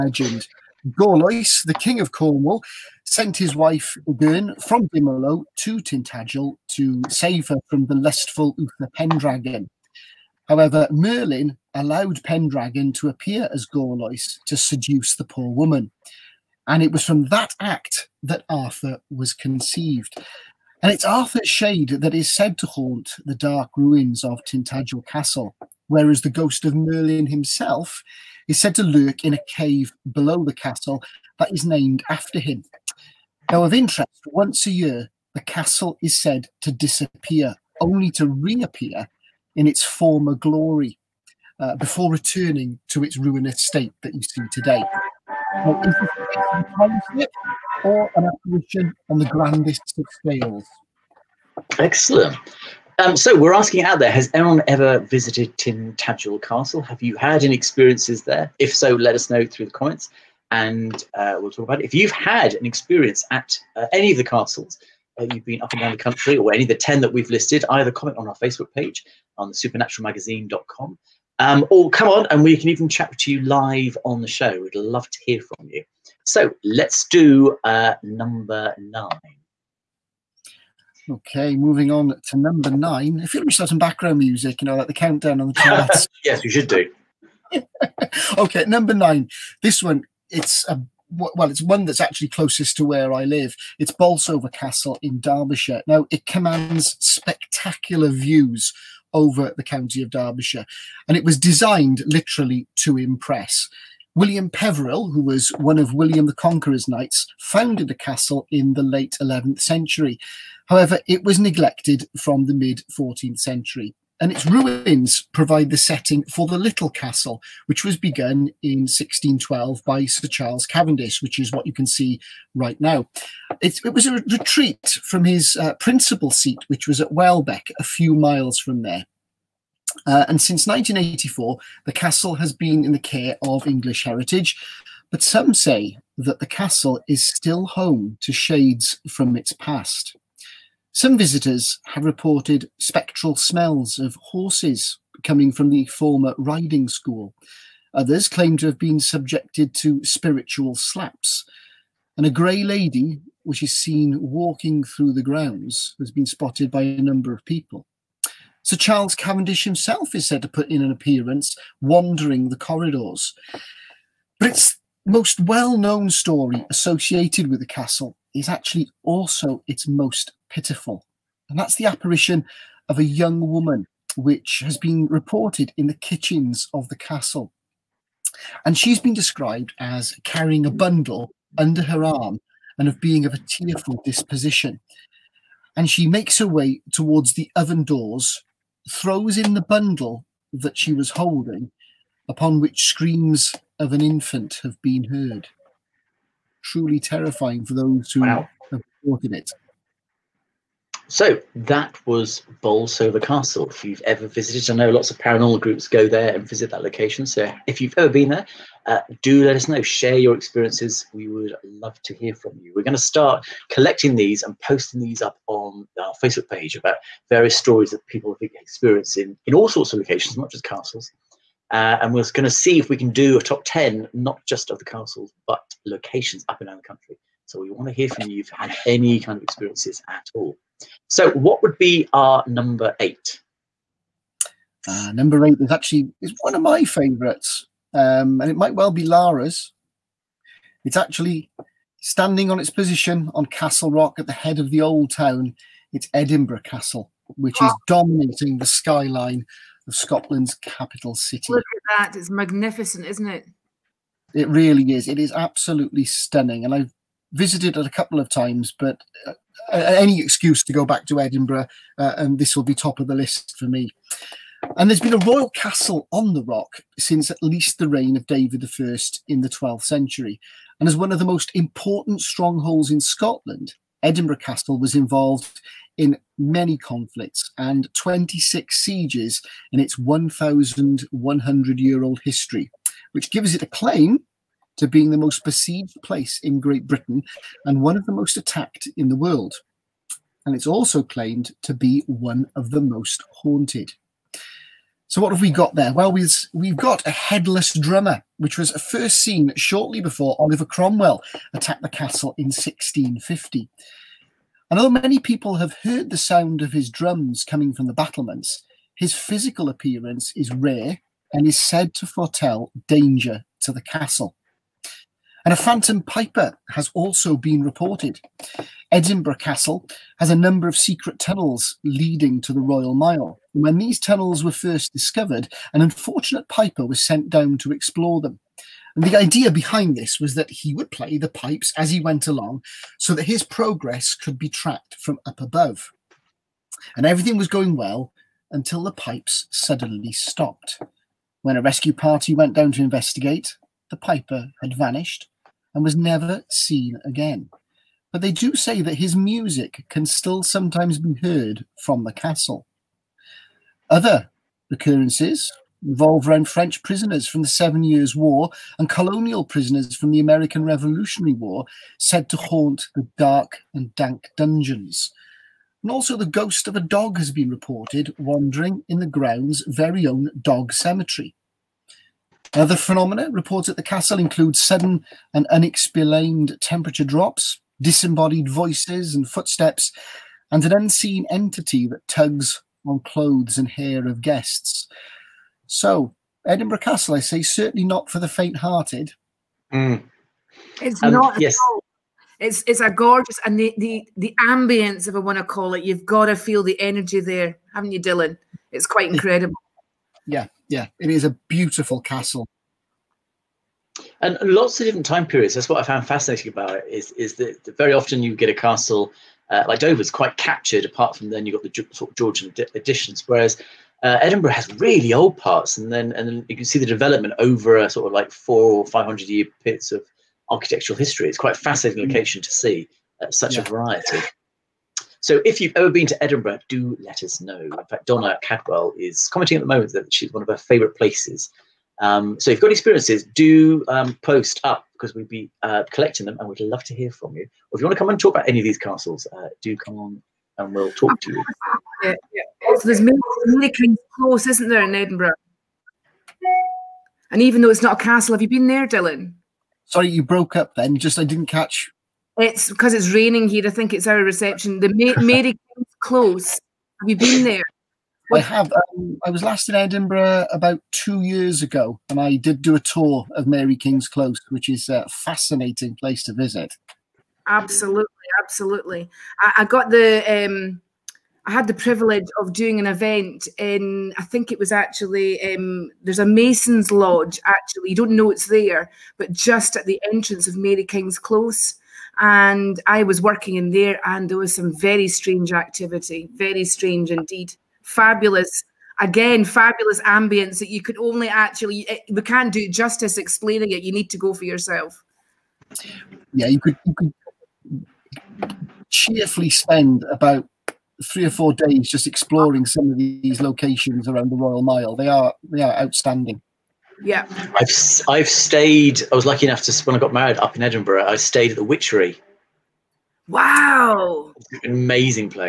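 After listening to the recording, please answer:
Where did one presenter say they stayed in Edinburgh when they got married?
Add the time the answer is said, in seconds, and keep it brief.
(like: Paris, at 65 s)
The Witchery, at 511 s.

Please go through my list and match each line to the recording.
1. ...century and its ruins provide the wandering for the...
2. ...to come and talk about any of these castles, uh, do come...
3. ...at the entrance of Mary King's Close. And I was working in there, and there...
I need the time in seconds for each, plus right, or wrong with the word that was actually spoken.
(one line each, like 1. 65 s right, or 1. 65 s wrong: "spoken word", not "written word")
1. 113 s wrong: "setting", not "wandering"
2. 437 s right
3. 479 s right.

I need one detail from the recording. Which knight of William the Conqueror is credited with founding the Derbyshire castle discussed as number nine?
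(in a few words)
William Peveril.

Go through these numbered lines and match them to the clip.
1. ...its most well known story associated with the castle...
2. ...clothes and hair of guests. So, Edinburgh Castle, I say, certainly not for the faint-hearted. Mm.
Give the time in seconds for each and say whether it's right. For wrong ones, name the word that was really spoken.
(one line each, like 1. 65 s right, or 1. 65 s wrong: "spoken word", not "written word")
1. 164 s right
2. 382 s right.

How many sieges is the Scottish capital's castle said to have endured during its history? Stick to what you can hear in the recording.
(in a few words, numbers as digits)
26.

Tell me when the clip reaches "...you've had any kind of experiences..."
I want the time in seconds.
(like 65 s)
228 s.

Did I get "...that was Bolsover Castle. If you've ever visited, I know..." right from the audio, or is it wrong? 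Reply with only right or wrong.
right.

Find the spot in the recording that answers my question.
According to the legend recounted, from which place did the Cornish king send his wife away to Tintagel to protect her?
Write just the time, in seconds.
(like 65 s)
4 s.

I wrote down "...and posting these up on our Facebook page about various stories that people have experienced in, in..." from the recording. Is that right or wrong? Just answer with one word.
right.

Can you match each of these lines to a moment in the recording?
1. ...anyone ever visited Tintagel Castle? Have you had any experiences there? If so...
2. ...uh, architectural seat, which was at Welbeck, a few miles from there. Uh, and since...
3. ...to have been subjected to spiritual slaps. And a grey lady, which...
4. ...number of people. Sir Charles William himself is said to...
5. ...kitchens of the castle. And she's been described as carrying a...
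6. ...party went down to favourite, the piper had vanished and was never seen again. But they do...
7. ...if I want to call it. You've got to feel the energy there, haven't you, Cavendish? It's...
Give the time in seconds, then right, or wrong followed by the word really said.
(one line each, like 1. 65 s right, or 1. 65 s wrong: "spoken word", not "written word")
1. 54 s right
2. 125 s wrong: "principal", not "architectural"
3. 148 s right
4. 157 s wrong: "Cavendish", not "William"
5. 175 s right
6. 341 s wrong: "investigate", not "favourite"
7. 395 s wrong: "Dylan", not "Cavendish".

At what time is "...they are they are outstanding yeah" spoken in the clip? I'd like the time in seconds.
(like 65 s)
504 s.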